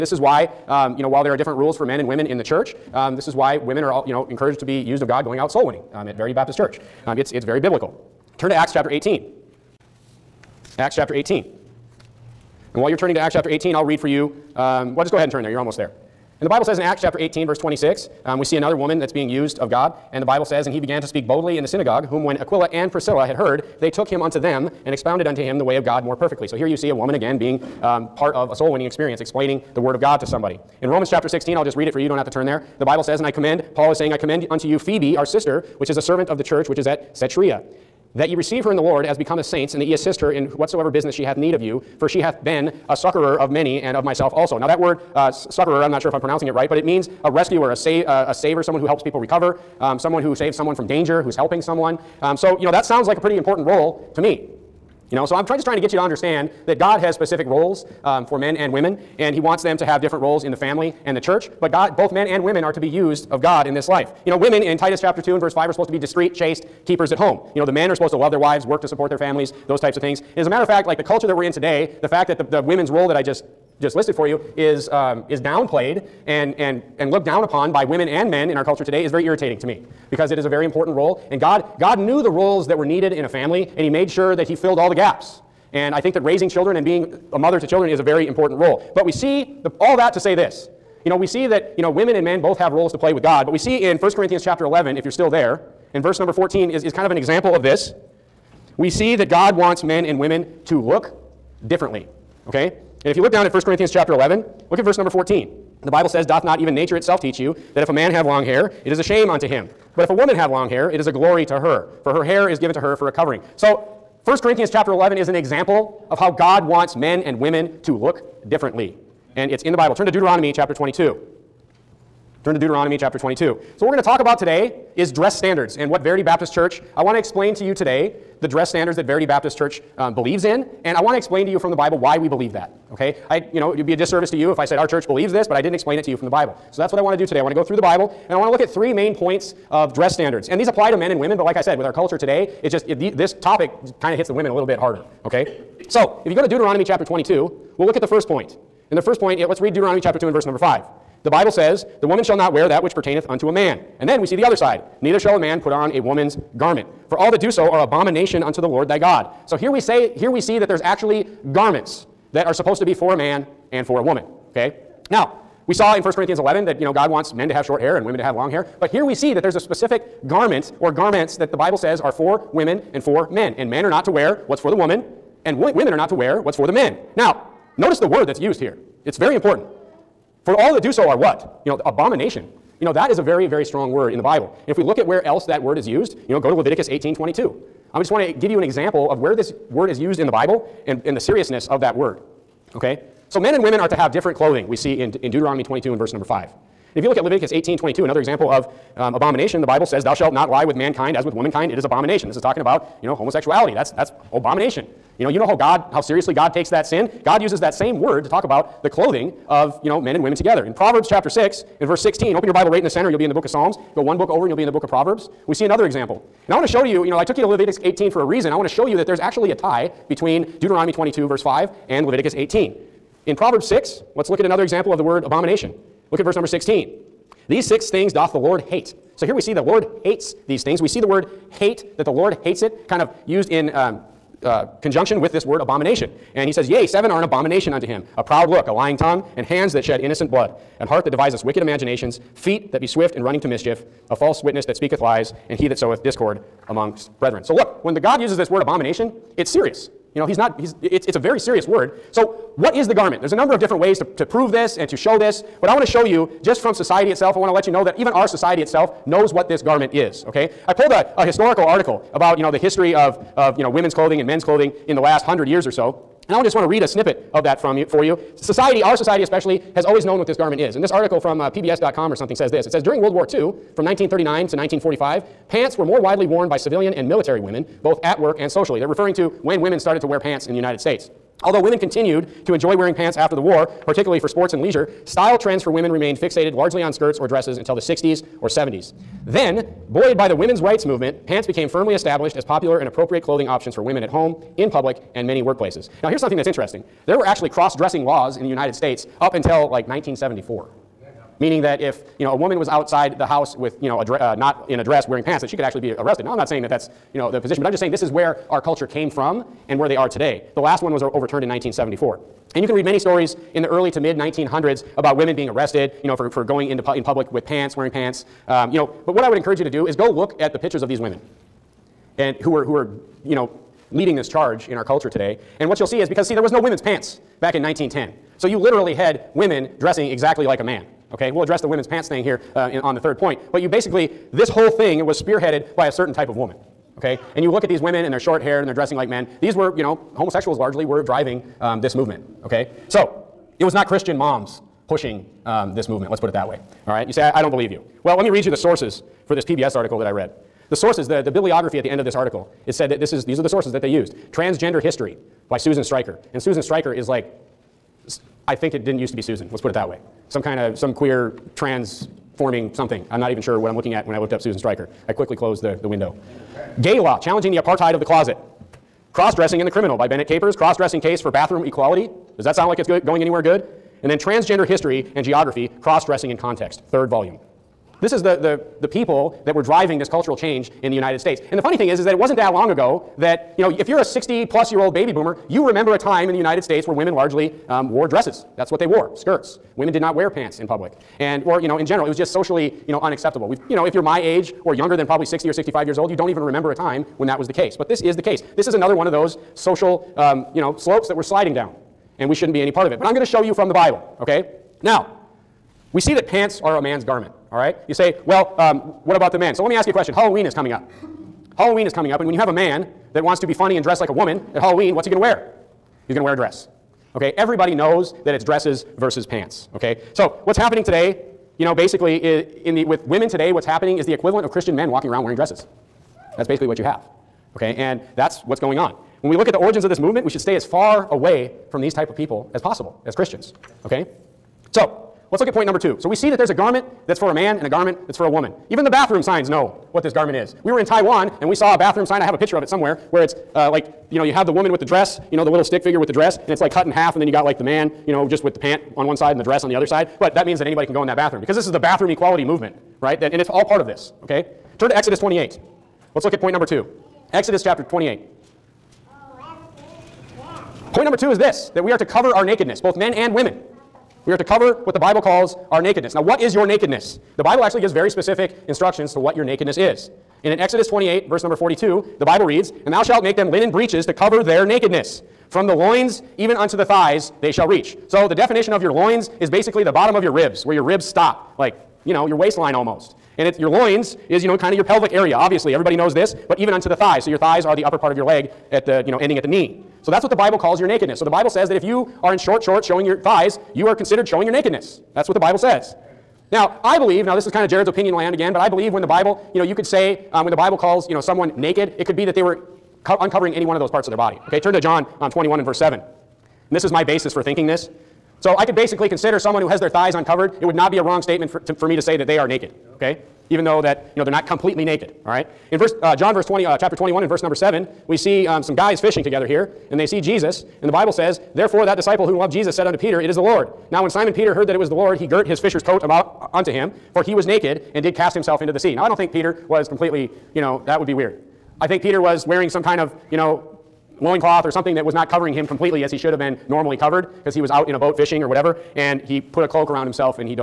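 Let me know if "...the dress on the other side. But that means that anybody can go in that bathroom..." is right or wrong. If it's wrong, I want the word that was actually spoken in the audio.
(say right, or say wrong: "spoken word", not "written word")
right.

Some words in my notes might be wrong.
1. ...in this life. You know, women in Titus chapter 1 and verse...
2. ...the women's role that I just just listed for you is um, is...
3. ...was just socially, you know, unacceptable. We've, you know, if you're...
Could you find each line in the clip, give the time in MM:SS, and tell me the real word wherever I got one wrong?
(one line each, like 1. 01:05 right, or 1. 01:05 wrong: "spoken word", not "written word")
1. 01:03 wrong: "2", not "1"
2. 01:12 right
3. 06:32 right.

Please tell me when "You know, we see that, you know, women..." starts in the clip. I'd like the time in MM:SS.
01:31.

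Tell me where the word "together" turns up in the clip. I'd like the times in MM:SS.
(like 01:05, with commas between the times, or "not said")
03:30, 08:39.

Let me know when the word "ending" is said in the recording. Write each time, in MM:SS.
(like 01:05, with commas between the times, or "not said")
08:09.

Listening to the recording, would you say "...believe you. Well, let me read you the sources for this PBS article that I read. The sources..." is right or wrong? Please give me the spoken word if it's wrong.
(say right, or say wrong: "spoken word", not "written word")
right.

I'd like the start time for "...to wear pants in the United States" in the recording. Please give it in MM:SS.
04:40.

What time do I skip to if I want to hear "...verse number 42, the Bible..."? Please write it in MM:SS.
07:51.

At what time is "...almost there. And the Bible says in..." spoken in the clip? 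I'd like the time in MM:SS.
00:15.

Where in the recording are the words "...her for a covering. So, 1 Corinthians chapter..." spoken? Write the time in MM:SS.
01:52.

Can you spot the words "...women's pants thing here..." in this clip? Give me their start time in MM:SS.
05:31.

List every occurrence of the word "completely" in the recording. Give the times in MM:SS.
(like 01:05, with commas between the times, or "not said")
08:34, 08:49, 08:55.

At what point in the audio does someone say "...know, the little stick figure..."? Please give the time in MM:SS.
07:25.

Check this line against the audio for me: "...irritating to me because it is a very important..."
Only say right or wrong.
right.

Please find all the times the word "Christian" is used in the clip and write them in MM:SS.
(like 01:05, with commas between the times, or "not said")
05:43, 07:04, 07:13.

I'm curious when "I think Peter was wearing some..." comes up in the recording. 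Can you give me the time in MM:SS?
08:51.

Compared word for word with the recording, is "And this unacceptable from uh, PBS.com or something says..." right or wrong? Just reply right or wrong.
wrong.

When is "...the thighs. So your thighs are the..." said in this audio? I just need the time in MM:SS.
08:06.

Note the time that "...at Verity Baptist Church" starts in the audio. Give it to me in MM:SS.
00:06.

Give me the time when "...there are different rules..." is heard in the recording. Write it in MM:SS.
00:01.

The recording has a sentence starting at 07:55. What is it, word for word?
From the loins even unto the thighs they shall reach.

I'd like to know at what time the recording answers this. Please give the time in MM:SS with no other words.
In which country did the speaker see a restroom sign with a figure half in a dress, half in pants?
07:20.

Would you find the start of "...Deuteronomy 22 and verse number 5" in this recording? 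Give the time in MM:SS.
03:15.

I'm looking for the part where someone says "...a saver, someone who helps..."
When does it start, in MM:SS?
00:48.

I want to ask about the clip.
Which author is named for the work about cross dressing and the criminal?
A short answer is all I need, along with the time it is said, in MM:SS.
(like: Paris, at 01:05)
Bennett Capers, at 06:10.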